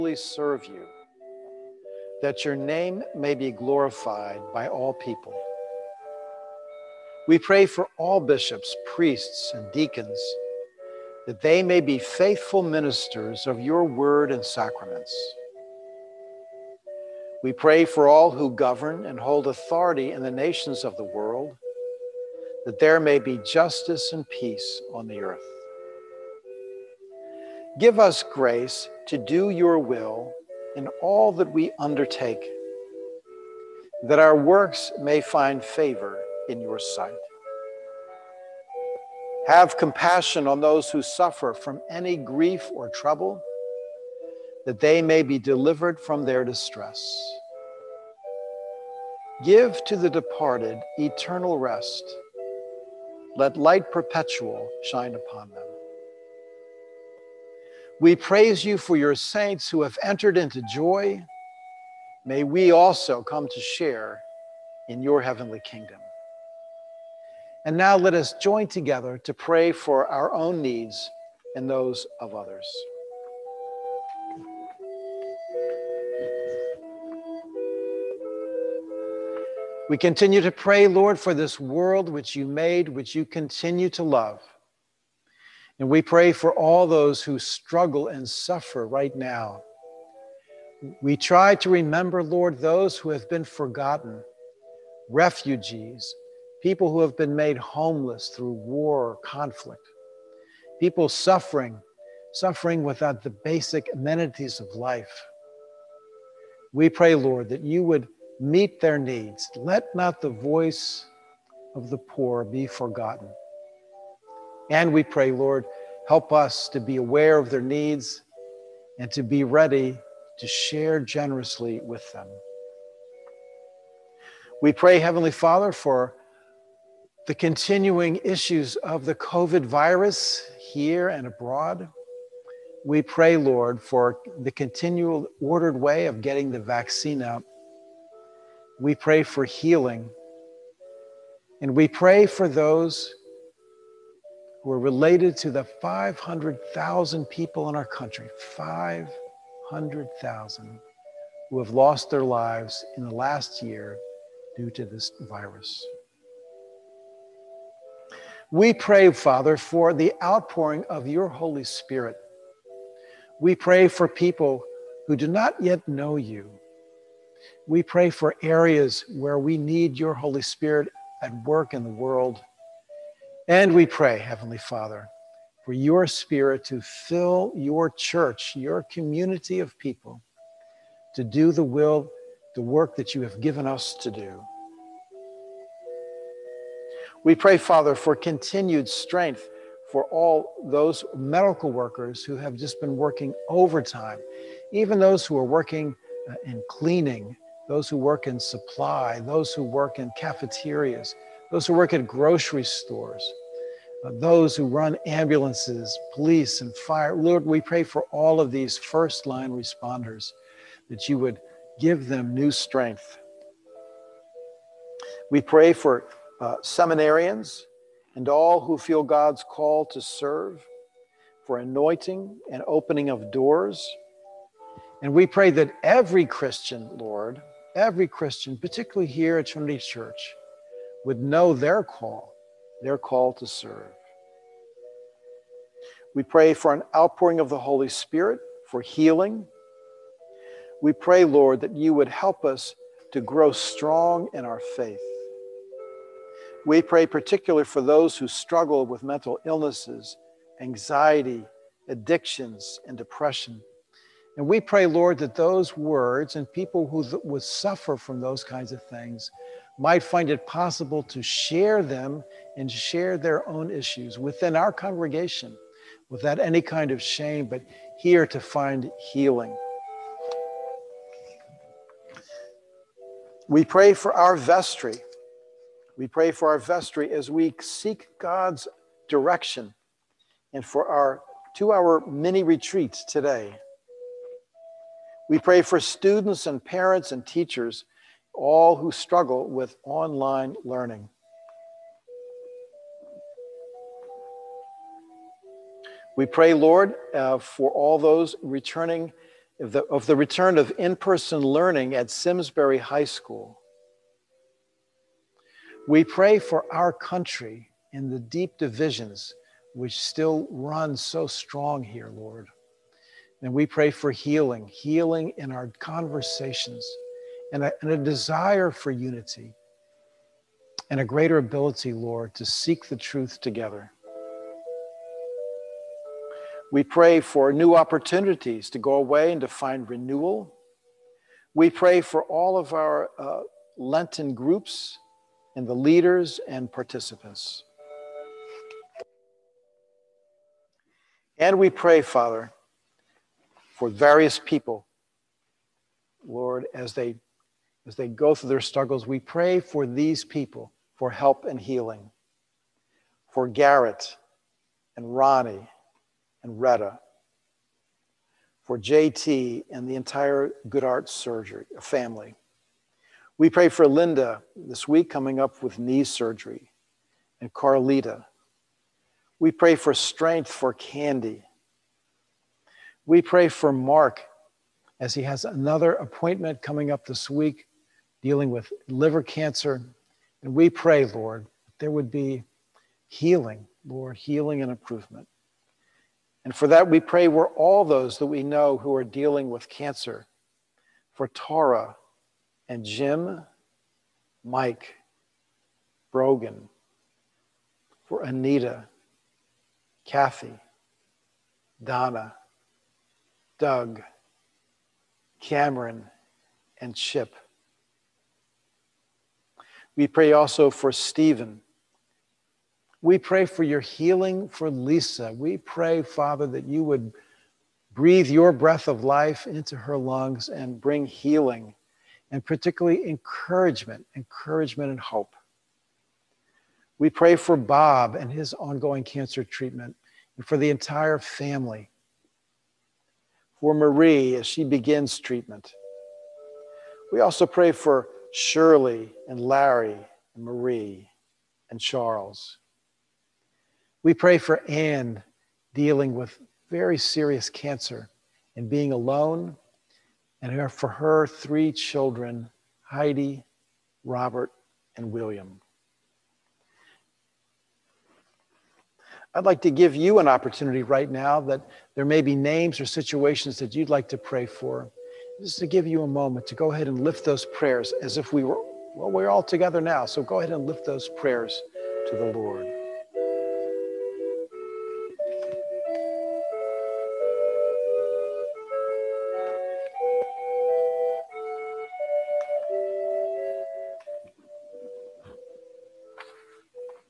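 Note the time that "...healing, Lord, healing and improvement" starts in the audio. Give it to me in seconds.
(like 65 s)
383 s.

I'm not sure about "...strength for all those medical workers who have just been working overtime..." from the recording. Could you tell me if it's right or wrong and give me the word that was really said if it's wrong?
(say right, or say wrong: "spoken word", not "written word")
right.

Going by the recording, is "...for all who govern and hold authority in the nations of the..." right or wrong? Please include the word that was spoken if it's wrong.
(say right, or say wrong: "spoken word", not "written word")
right.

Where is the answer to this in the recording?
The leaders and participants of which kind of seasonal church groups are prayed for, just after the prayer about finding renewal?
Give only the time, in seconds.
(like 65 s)
333 s.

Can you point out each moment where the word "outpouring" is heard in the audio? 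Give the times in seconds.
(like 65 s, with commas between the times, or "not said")
160 s, 236 s.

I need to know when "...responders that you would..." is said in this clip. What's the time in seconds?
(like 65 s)
209 s.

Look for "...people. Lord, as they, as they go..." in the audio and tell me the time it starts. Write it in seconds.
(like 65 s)
344 s.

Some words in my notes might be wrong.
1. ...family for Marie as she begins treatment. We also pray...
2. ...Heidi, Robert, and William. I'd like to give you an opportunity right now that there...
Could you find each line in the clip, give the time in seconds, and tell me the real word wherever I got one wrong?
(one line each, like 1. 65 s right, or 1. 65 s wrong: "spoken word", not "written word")
1. 431 s right
2. 452 s right.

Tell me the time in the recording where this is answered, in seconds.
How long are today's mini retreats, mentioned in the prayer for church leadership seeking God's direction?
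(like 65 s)
281 s.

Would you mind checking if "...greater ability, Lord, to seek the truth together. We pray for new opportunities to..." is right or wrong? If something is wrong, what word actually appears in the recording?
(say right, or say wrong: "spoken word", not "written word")
right.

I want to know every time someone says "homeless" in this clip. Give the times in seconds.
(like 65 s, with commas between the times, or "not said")
97 s.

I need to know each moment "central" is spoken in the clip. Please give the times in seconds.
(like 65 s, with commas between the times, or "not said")
not said.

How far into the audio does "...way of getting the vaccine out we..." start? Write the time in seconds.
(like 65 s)
135 s.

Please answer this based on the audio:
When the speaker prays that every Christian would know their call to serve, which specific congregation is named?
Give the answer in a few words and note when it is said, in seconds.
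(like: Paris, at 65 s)
Trinity Church, at 229 s.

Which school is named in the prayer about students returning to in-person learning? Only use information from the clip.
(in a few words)
Simsbury High School.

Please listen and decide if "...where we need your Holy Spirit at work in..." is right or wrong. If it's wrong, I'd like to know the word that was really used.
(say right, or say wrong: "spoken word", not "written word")
right.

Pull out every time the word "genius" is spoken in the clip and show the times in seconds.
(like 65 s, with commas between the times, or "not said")
not said.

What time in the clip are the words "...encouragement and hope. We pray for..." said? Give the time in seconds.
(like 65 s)
424 s.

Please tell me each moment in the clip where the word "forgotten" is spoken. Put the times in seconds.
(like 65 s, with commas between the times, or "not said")
93 s, 112 s.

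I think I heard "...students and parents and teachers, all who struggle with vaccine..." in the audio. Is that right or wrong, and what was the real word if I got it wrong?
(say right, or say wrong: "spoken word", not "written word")
wrong: "online", not "vaccine".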